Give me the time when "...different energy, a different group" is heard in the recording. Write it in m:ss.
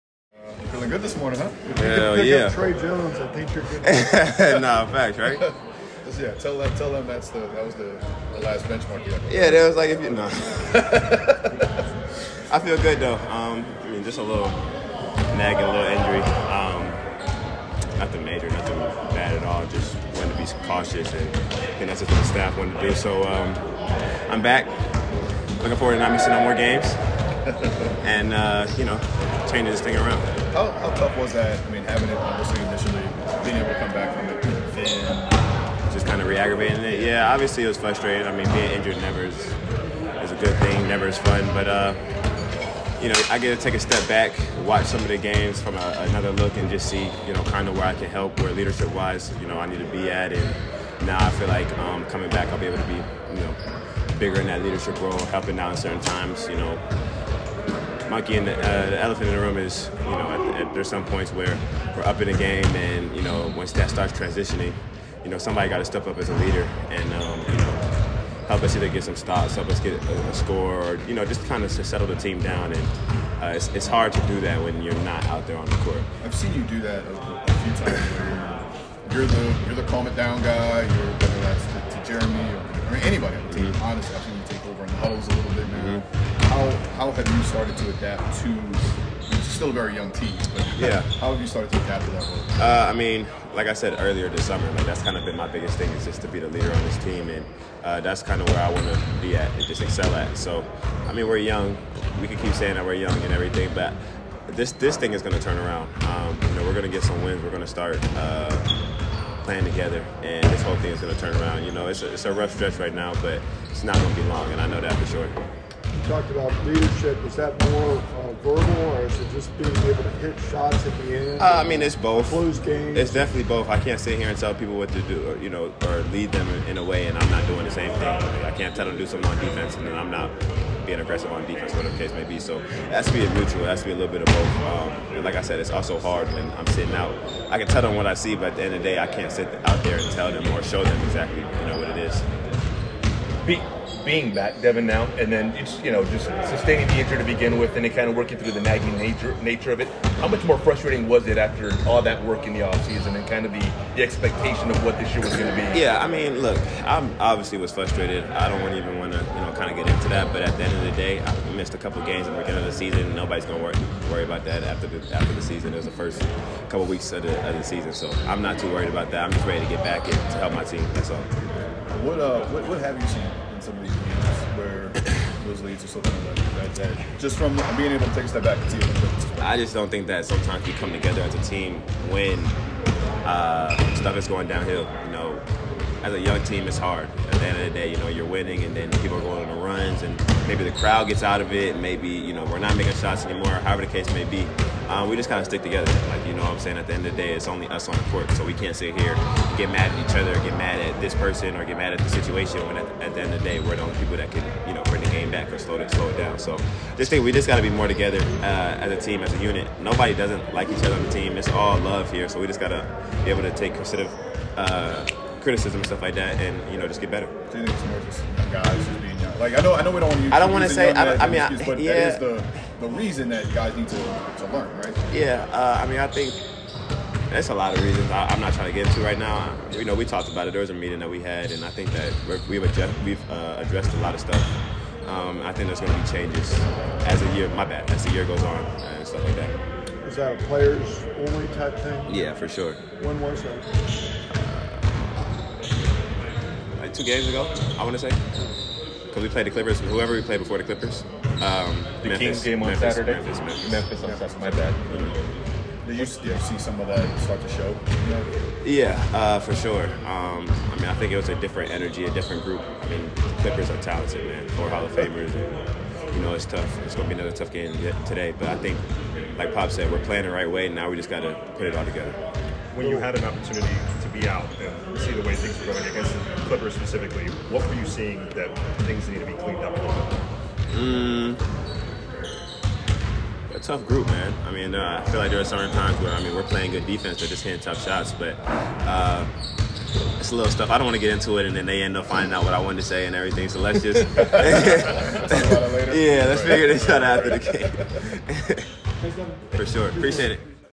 4:21.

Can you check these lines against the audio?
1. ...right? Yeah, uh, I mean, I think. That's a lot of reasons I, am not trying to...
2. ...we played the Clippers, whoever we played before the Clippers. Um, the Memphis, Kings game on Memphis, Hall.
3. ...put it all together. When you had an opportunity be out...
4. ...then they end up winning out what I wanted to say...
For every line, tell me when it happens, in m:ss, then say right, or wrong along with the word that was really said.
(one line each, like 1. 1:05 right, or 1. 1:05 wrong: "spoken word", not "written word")
1. 3:44 right
2. 4:09 wrong: "Saturday", not "Hall"
3. 4:31 right
4. 4:51 wrong: "finding", not "winning".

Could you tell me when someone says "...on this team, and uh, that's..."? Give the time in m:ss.
1:36.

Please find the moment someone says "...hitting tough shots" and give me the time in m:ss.
4:47.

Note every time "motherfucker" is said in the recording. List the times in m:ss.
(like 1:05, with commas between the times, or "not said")
not said.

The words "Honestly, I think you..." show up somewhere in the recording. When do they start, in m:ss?
1:23.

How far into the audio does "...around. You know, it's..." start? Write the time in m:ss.
1:51.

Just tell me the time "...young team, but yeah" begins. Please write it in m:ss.
1:29.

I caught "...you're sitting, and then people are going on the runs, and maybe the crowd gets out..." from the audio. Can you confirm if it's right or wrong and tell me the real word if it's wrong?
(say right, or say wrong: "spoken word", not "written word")
wrong: "winning", not "sitting".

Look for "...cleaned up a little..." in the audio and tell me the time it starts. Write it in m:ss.
4:39.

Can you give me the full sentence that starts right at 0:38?
I mean, being injured never is, is a good thing, never is fun, but.